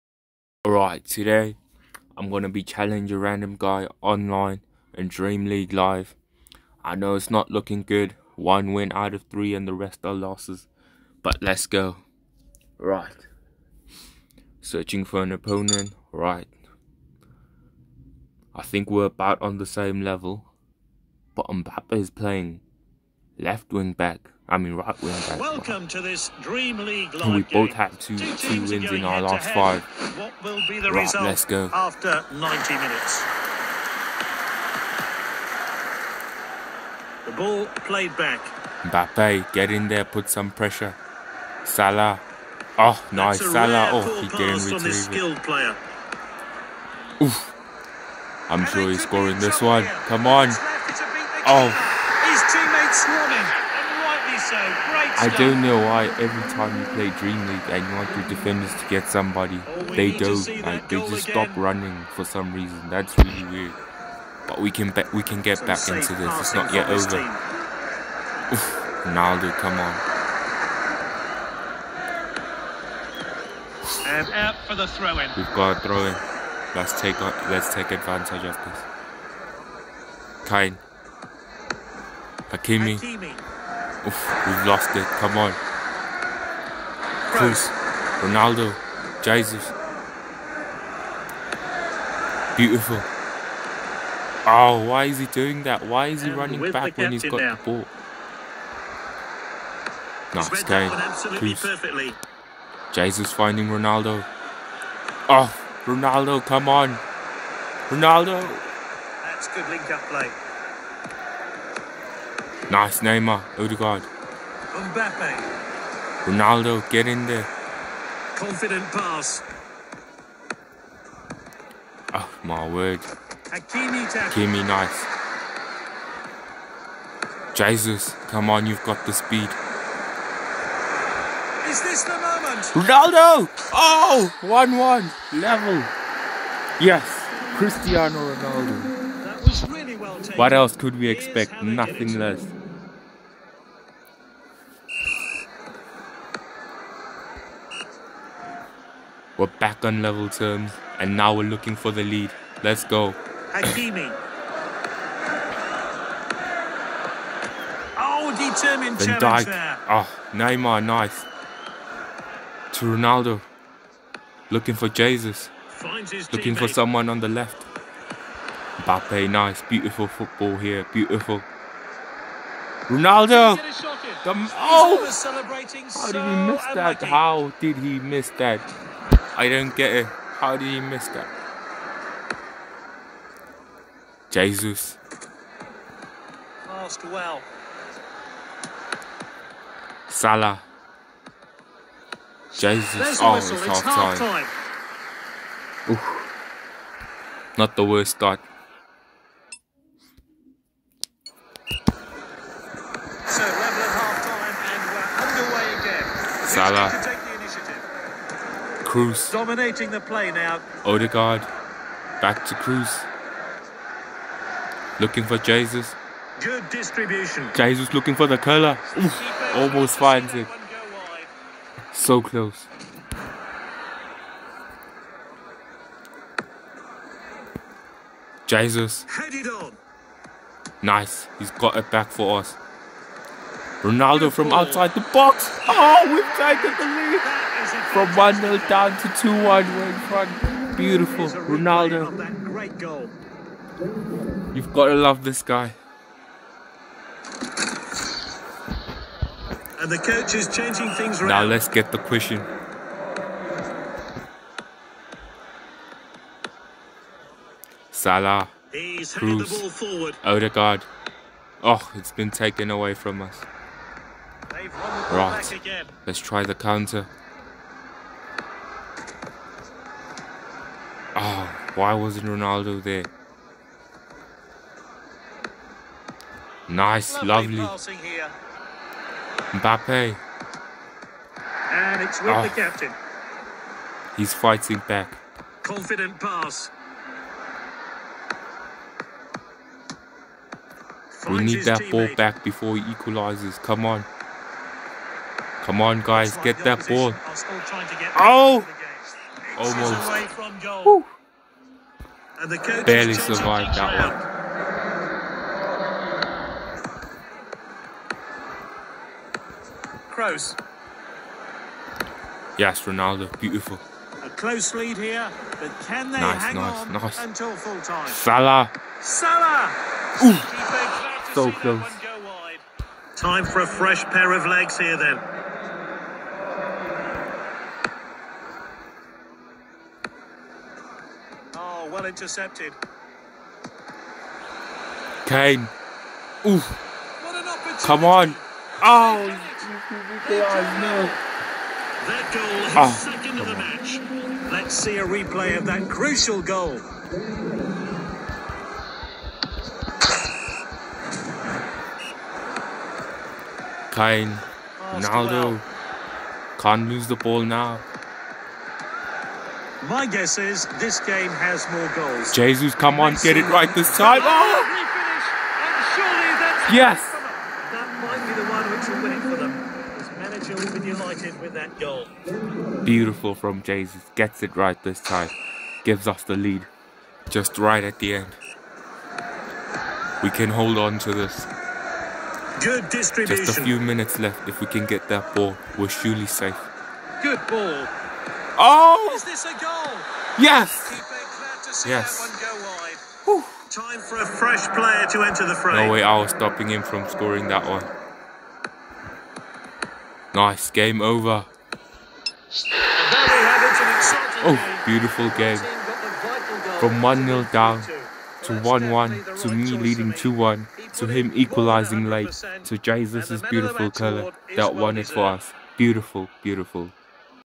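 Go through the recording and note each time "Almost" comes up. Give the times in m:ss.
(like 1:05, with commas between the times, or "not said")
3:39, 4:59.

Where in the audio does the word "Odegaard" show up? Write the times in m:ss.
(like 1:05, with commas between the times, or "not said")
1:53, 3:30, 4:20.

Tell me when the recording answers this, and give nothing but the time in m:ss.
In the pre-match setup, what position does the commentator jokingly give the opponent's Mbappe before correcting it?
0:23.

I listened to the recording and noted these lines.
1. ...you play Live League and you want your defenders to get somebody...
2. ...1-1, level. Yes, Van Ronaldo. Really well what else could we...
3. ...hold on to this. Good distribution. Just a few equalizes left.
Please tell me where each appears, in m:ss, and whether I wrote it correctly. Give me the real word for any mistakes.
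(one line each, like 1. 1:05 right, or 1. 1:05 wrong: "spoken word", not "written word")
1. 0:56 wrong: "Dream", not "Live"
2. 2:14 wrong: "Cristiano", not "Van"
3. 6:20 wrong: "minutes", not "equalizes".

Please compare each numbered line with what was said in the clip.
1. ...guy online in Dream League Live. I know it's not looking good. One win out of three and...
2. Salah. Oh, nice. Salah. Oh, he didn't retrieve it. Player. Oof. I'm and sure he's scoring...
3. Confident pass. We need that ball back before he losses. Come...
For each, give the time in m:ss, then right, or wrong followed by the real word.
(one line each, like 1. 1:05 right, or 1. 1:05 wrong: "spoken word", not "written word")
1. 0:03 right
2. 0:41 right
3. 4:45 wrong: "equalizes", not "losses".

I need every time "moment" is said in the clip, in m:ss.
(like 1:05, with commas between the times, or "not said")
2:12.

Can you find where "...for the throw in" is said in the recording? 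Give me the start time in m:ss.
1:14.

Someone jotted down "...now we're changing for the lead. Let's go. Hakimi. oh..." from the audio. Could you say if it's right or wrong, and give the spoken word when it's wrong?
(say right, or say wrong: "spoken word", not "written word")
wrong: "looking", not "changing".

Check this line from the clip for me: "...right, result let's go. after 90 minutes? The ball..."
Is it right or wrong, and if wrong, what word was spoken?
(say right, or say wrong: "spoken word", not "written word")
right.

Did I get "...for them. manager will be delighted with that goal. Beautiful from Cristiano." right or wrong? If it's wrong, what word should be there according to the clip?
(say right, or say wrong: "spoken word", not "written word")
wrong: "Jesus", not "Cristiano".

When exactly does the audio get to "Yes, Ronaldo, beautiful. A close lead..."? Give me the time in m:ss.
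5:12.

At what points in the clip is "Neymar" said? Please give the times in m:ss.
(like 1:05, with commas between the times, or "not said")
1:53, 2:40.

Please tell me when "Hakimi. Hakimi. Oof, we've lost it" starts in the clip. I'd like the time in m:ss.
1:22.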